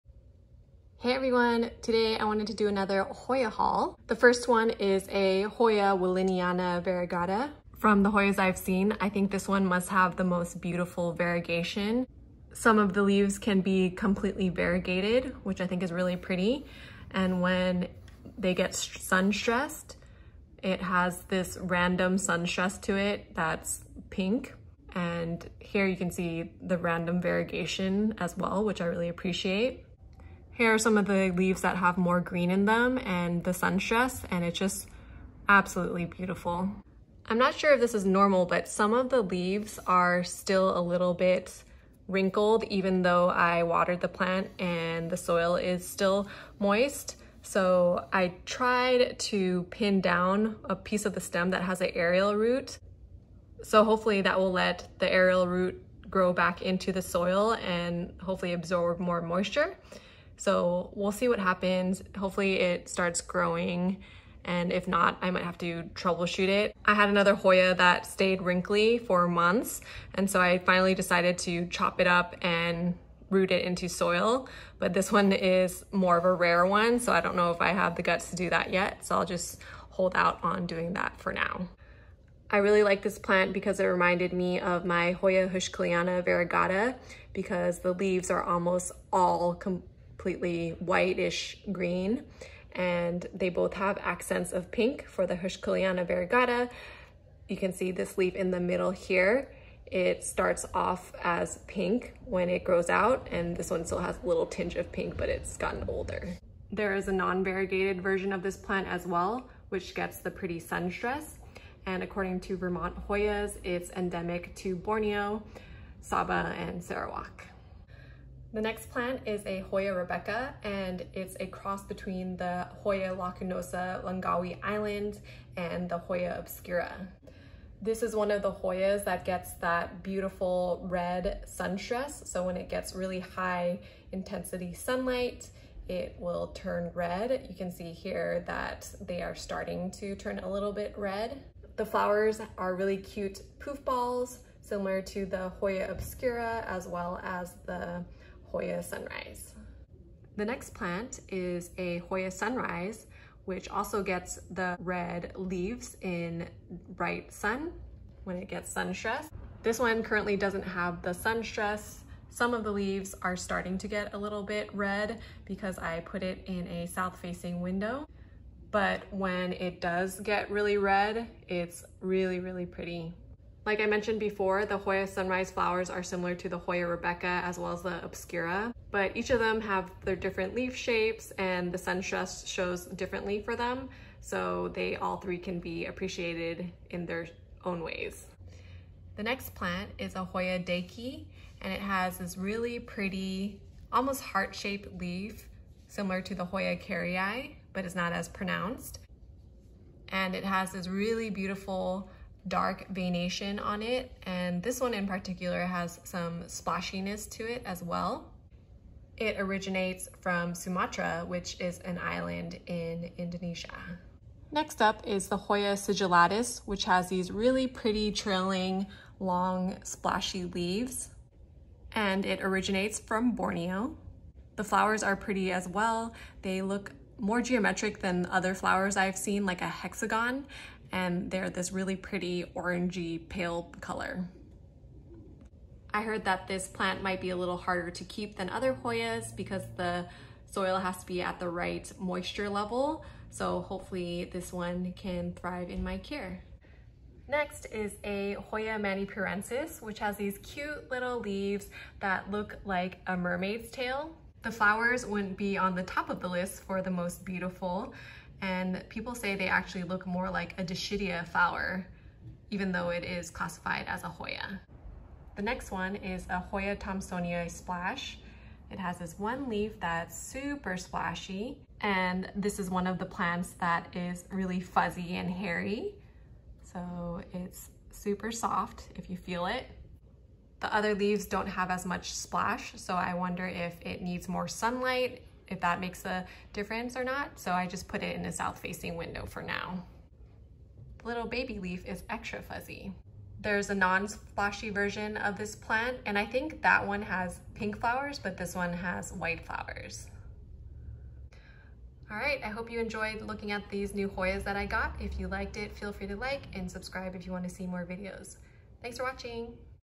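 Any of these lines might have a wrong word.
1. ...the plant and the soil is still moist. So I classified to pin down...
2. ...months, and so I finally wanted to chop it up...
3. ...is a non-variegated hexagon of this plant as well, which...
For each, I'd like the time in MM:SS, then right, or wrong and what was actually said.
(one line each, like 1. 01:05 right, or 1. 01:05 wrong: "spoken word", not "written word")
1. 00:44 wrong: "tried", not "classified"
2. 01:09 wrong: "decided", not "wanted"
3. 01:46 wrong: "version", not "hexagon".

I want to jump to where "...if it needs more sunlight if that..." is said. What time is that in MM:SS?
04:43.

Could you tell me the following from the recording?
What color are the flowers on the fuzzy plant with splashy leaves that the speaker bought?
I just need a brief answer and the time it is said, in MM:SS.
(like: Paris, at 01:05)
white, at 04:59.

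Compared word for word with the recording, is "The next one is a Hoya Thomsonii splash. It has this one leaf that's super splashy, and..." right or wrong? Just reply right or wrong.
right.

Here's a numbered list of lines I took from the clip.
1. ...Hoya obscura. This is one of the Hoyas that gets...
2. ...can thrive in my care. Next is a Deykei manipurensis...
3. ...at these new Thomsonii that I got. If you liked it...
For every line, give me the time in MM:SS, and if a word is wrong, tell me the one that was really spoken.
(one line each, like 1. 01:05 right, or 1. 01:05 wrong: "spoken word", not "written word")
1. 02:05 right
2. 04:04 wrong: "Hoya", not "Deykei"
3. 05:03 wrong: "Hoyas", not "Thomsonii".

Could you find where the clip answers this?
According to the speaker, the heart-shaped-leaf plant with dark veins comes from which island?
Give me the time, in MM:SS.
03:30.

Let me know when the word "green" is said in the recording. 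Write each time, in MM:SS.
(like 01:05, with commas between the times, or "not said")
00:32, 01:31.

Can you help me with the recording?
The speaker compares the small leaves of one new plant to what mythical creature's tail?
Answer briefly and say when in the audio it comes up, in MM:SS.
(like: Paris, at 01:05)
a mermaid, at 04:13.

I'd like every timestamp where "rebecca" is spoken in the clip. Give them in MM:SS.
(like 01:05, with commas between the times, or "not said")
01:59, 02:56.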